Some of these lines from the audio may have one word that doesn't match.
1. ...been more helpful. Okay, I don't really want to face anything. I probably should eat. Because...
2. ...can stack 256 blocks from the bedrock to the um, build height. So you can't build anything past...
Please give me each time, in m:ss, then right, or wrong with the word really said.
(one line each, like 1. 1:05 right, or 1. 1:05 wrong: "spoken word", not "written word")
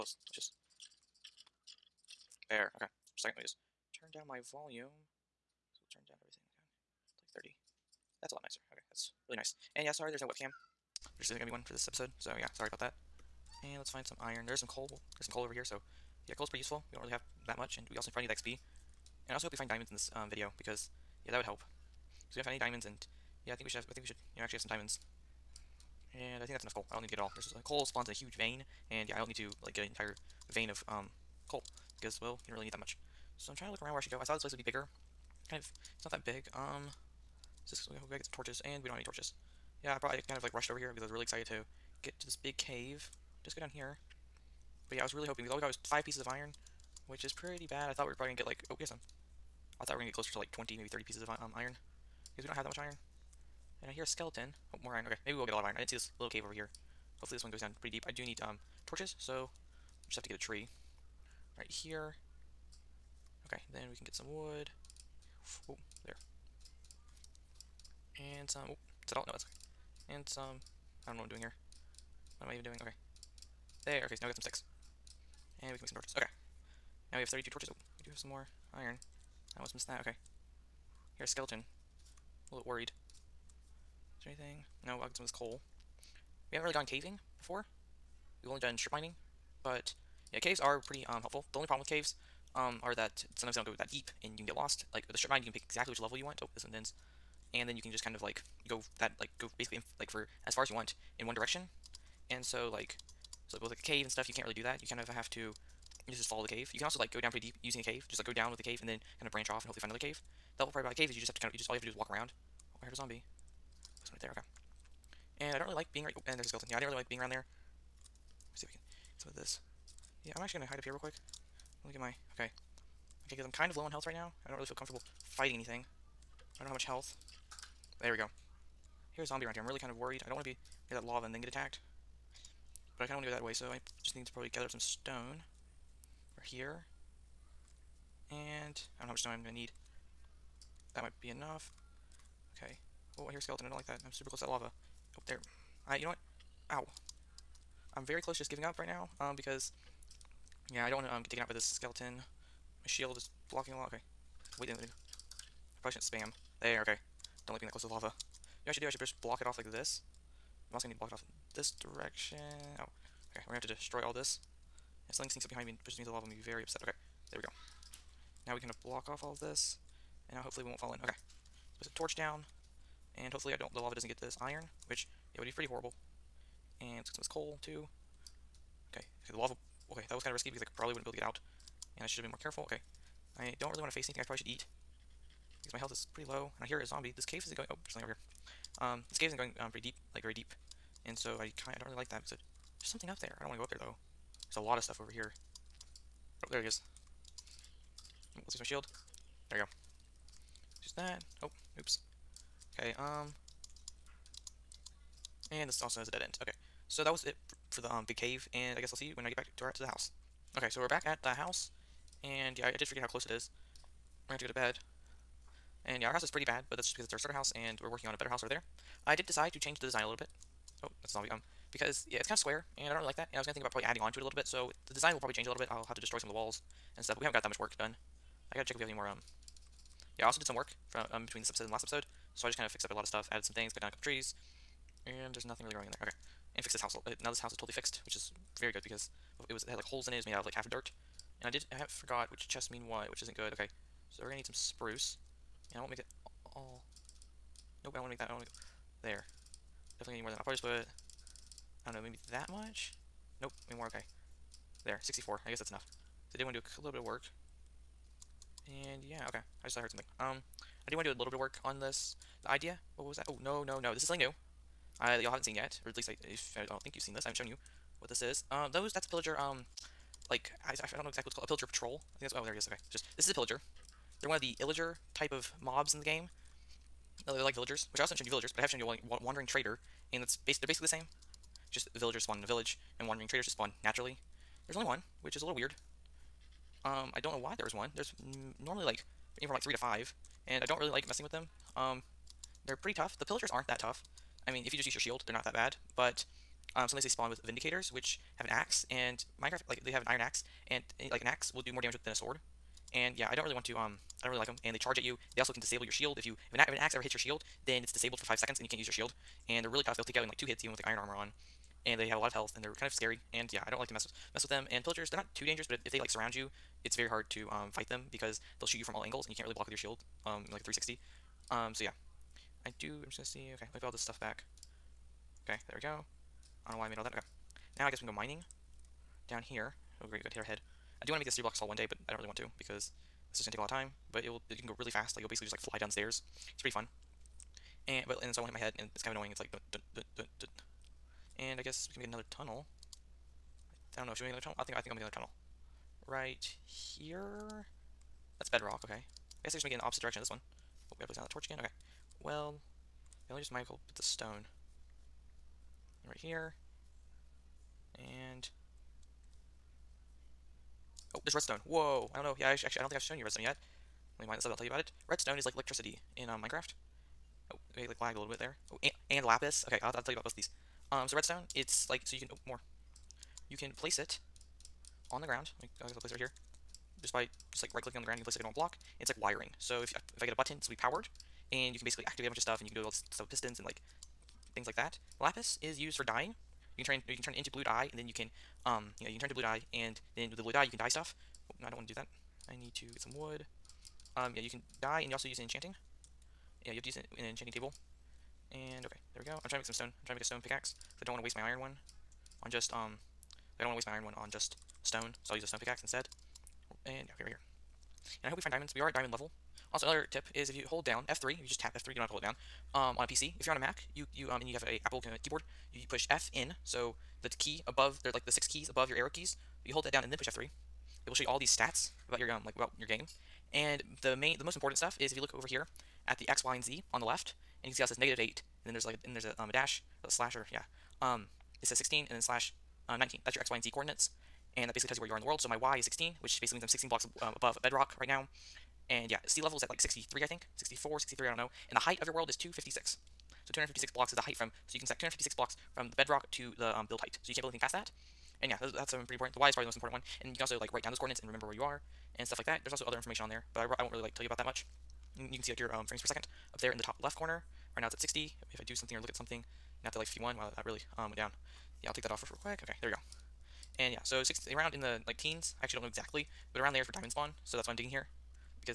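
1. 3:02 wrong: "careful", not "helpful"
2. 7:24 right.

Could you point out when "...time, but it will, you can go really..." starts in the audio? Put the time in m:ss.
5:33.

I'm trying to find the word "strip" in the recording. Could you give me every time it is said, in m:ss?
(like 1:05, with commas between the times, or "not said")
1:28, 1:35.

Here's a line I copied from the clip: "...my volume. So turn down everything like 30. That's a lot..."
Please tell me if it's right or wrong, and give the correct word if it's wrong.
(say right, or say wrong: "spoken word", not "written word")
right.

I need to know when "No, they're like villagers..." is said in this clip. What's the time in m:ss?
4:37.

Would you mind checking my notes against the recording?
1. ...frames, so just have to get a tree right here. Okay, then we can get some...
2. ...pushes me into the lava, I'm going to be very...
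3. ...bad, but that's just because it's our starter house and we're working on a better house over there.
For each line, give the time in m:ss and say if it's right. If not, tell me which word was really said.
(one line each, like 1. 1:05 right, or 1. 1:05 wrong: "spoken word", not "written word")
1. 0:58 wrong: "torches", not "frames"
2. 2:45 right
3. 3:36 right.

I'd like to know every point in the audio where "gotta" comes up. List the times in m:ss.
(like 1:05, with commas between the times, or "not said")
0:38, 3:48, 5:51.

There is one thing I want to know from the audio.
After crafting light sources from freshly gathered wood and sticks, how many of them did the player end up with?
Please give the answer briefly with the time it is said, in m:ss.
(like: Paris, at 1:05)
32, at 1:17.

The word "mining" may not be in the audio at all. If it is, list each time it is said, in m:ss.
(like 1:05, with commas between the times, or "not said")
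1:28, 5:28.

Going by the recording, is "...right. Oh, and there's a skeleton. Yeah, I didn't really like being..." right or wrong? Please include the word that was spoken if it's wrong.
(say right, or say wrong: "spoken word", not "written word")
right.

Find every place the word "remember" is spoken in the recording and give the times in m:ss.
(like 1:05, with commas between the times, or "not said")
7:31.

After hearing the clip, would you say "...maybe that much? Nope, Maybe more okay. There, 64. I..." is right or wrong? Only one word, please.
right.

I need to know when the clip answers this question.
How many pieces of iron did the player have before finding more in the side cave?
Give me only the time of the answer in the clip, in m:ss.
0:45.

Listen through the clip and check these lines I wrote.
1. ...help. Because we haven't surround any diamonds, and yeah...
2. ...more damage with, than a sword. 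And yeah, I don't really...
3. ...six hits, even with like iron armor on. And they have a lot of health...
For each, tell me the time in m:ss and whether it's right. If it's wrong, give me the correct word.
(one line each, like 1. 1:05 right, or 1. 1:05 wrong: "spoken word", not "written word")
1. 0:21 wrong: "found", not "surround"
2. 5:01 right
3. 5:10 wrong: "two", not "six".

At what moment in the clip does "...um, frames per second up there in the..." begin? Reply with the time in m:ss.
7:35.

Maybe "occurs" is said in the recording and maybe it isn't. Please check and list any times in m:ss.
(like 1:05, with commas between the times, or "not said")
not said.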